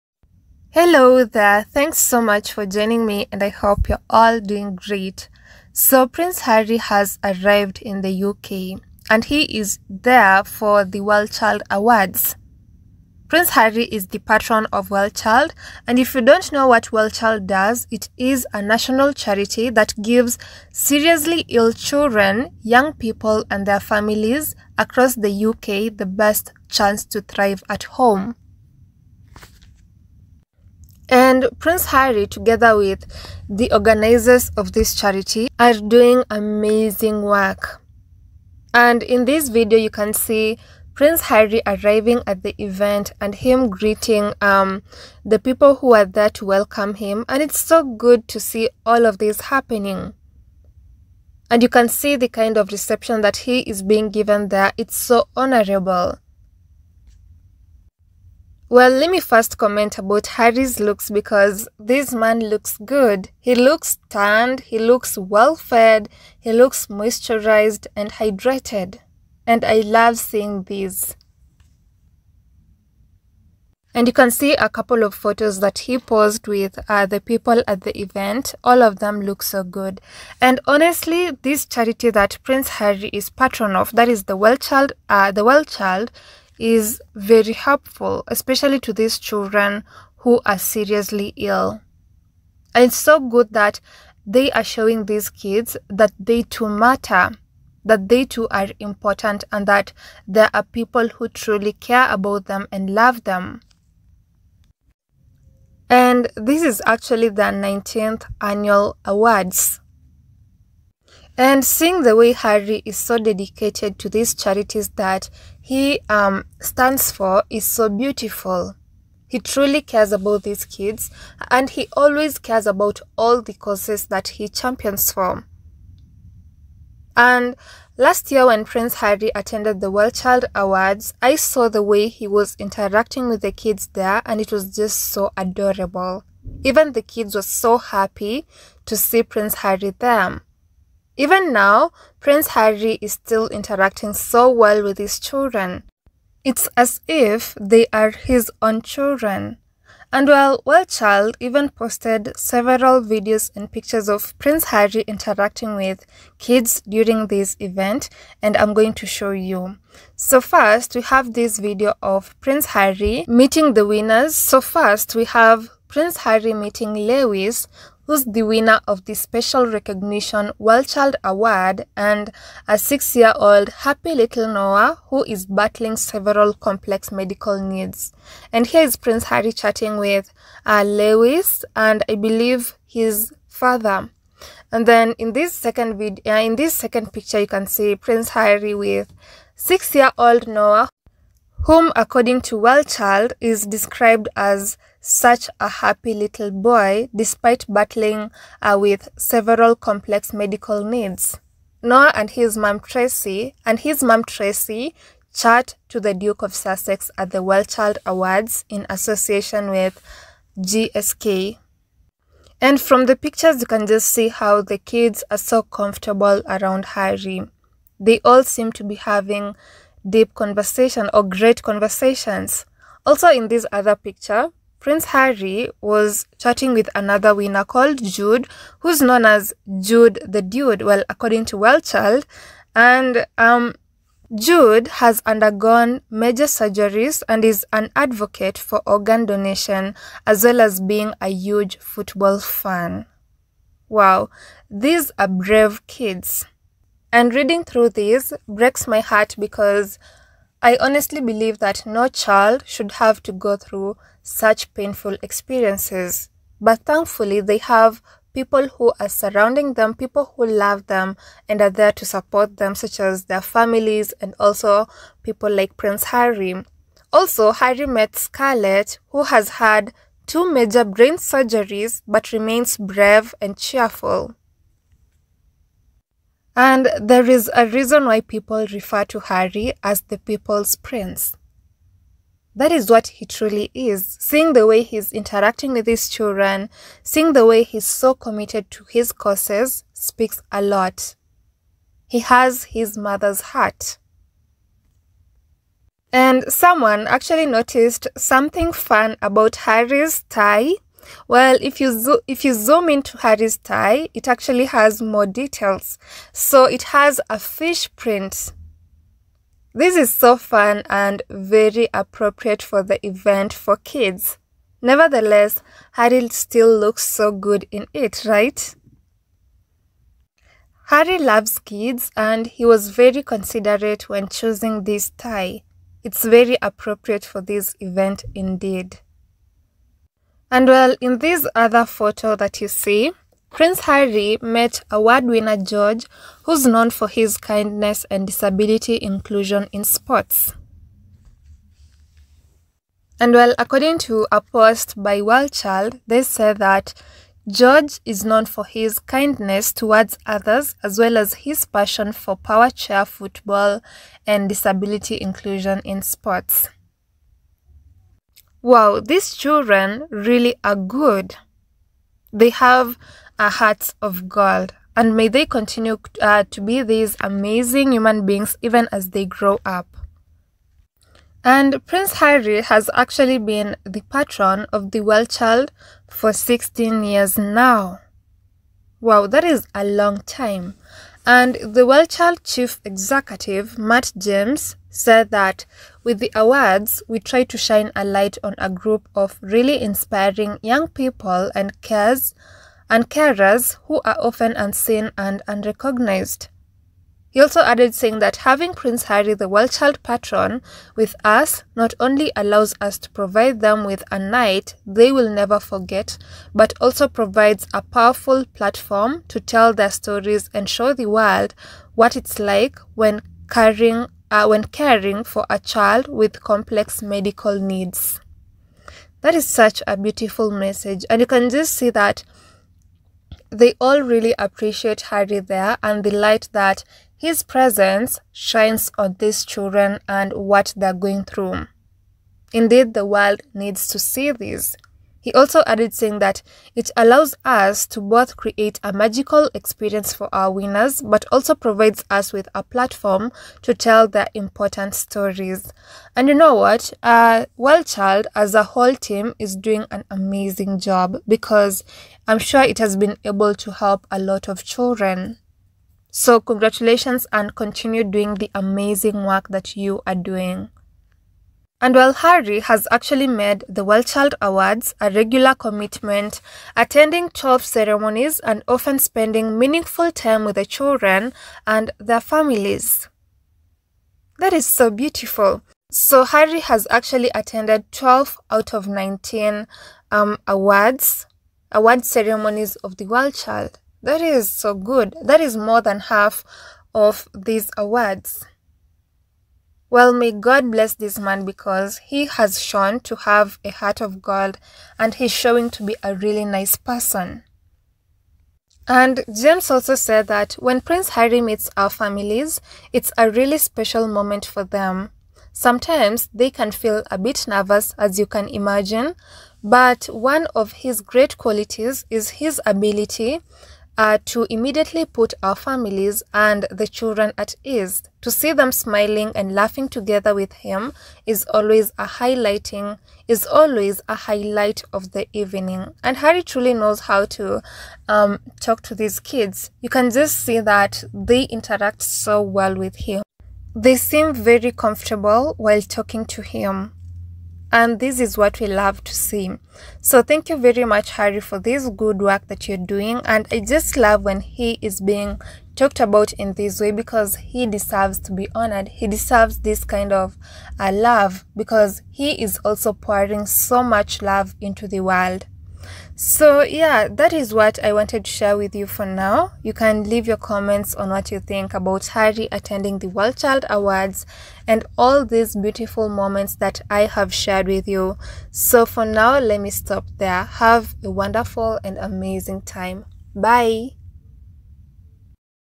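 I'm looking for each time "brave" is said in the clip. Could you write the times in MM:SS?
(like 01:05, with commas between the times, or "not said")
04:05, 04:32.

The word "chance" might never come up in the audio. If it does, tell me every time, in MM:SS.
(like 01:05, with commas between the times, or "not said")
00:26.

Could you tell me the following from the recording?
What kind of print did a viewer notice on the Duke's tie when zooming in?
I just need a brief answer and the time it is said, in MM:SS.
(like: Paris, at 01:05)
fish print, at 05:07.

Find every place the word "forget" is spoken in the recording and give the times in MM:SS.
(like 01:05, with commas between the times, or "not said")
06:45.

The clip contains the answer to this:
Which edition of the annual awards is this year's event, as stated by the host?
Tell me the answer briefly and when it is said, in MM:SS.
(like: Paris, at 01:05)
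19th, at 01:47.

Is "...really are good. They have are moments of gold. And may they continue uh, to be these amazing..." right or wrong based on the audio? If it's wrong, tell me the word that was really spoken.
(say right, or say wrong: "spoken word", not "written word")
wrong: "hearts", not "moments".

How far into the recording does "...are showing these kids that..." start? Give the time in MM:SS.
01:34.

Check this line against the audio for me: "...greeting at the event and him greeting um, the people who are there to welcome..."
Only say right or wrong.
wrong.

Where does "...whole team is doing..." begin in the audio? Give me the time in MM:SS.
07:28.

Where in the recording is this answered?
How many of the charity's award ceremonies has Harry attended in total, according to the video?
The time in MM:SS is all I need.
07:47.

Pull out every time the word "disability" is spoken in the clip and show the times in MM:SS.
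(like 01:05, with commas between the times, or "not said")
05:38, 05:54.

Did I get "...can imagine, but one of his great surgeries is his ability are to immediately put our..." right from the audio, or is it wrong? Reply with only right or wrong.
wrong.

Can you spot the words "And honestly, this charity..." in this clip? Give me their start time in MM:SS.
01:20.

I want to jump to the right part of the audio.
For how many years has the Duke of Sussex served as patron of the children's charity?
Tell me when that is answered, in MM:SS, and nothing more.
06:16.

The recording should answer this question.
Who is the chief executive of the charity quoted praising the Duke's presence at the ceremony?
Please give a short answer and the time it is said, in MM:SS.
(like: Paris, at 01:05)
Matt James, at 06:23.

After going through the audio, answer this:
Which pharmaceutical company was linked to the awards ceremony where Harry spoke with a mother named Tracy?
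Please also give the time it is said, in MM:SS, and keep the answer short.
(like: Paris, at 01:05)
GSK, at 03:30.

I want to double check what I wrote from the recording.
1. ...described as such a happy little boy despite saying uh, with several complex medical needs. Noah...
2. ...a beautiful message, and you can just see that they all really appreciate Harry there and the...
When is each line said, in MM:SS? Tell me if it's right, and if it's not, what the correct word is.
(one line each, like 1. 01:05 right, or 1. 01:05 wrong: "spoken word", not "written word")
1. 03:13 wrong: "battling", not "saying"
2. 06:59 right.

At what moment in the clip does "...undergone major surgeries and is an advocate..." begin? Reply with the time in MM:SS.
03:55.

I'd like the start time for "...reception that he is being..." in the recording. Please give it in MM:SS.
00:52.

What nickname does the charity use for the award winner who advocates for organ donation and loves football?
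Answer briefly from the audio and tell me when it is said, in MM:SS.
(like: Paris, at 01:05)
Jude the Dude, at 03:49.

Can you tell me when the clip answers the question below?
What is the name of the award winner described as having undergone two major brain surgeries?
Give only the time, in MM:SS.
04:28.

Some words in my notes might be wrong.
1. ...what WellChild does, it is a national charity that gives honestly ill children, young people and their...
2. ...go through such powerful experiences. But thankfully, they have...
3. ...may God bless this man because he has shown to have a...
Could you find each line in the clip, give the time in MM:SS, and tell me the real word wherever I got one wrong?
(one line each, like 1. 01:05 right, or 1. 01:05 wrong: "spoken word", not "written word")
1. 00:16 wrong: "seriously", not "honestly"
2. 04:13 wrong: "painful", not "powerful"
3. 08:10 right.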